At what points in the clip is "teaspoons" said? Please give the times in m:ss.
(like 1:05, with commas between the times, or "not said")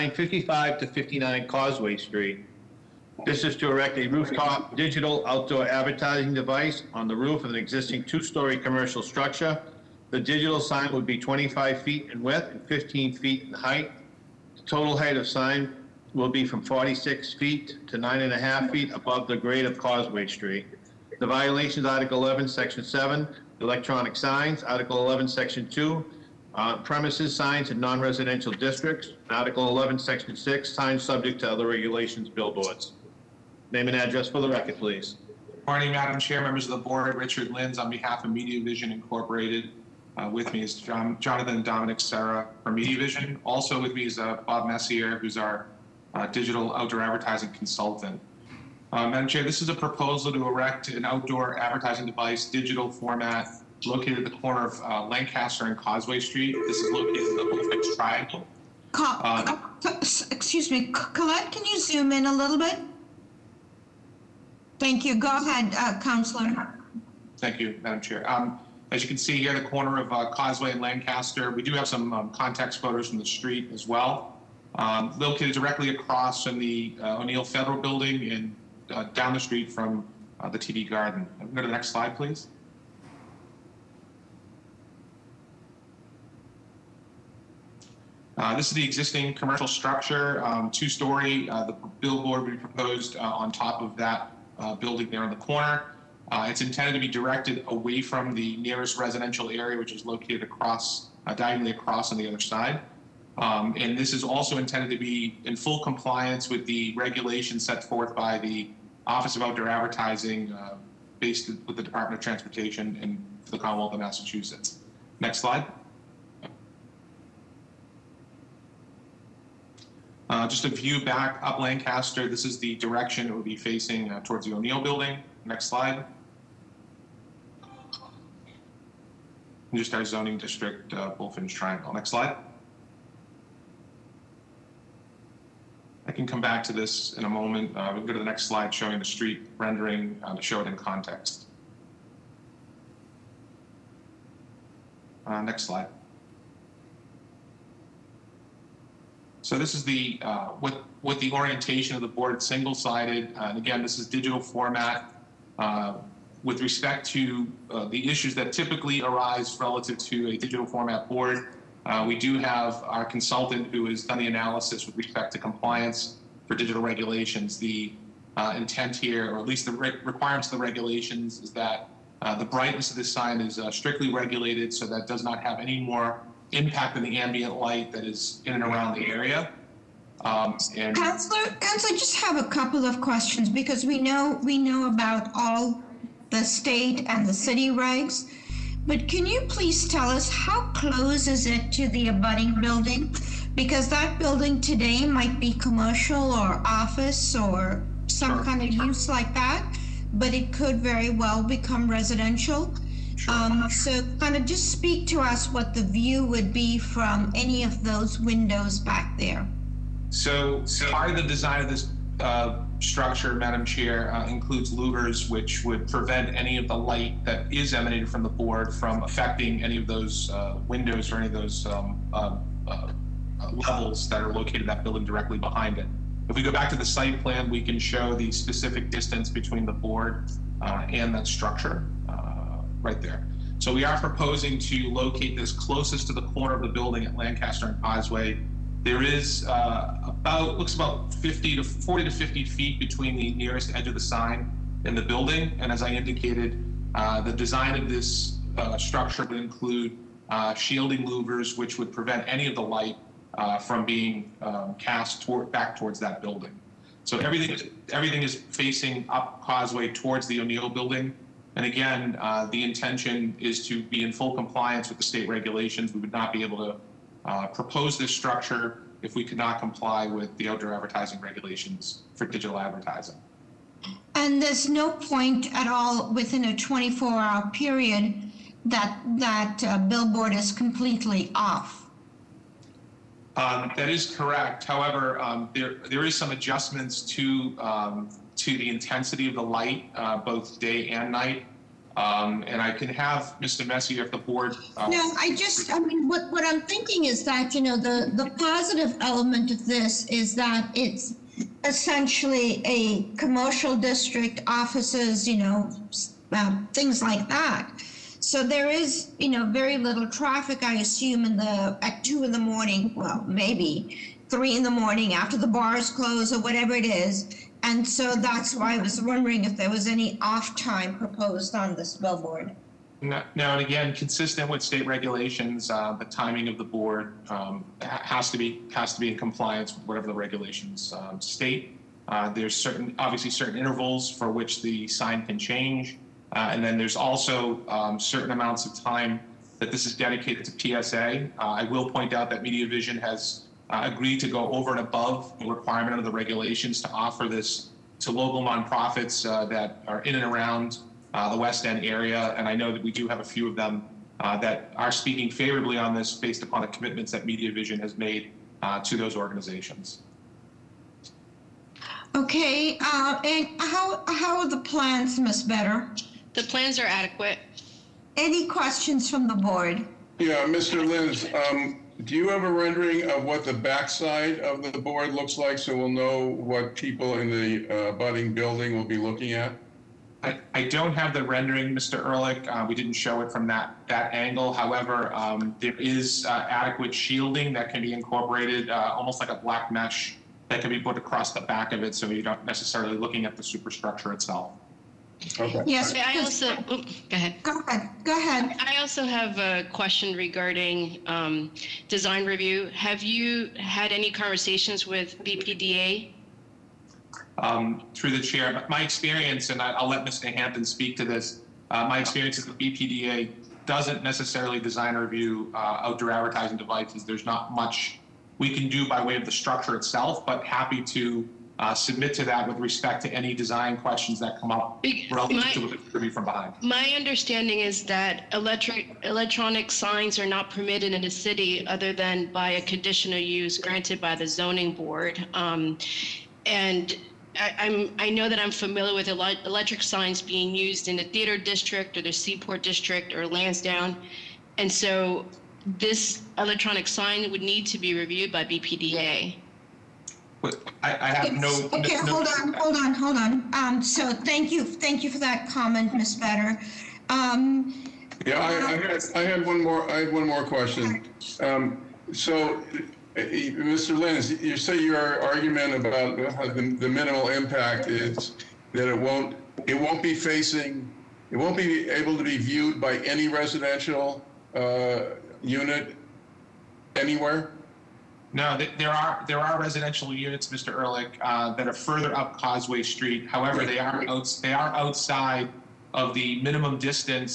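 not said.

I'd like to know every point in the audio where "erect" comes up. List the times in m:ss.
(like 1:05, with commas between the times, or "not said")
0:03, 0:50.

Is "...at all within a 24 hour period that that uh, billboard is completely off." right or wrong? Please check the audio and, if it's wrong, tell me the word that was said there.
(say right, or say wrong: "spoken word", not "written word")
right.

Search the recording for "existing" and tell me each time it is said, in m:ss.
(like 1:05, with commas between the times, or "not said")
0:07, 1:28.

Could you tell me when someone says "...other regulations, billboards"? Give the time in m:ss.
0:31.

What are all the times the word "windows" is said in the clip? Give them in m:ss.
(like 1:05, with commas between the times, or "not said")
3:28, 3:40.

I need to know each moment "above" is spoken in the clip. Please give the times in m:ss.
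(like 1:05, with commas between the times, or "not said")
0:18, 5:44.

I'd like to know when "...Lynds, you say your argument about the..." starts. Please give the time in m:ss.
7:43.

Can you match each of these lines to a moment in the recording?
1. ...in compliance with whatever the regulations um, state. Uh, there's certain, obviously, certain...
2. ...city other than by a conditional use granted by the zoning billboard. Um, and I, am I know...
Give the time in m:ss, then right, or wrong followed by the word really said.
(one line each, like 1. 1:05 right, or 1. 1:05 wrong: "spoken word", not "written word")
1. 5:29 right
2. 7:11 wrong: "board", not "billboard".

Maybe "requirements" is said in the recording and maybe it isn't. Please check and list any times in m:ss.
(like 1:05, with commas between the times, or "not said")
2:50, 5:45.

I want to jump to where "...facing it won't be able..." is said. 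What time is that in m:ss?
7:50.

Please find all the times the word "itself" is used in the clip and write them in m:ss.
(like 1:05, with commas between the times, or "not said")
6:34, 6:59.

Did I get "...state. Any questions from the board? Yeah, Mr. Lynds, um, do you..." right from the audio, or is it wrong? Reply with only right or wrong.
wrong.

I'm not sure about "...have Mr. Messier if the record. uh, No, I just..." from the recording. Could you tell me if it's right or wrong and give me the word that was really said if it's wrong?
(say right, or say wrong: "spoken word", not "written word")
wrong: "board", not "record".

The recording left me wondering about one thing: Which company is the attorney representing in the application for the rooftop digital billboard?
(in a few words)
Media Vision Incorporated.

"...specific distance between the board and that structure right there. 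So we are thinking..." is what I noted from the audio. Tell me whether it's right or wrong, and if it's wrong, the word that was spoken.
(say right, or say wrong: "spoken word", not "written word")
wrong: "proposing", not "thinking".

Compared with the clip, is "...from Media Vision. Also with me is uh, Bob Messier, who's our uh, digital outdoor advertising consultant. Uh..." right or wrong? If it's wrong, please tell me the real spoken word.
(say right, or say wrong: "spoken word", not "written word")
right.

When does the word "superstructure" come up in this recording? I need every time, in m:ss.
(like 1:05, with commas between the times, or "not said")
6:33.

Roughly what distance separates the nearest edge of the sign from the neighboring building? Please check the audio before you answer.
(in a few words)
40 to 50 feet.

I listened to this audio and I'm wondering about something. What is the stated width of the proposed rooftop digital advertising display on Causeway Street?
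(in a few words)
25 feet.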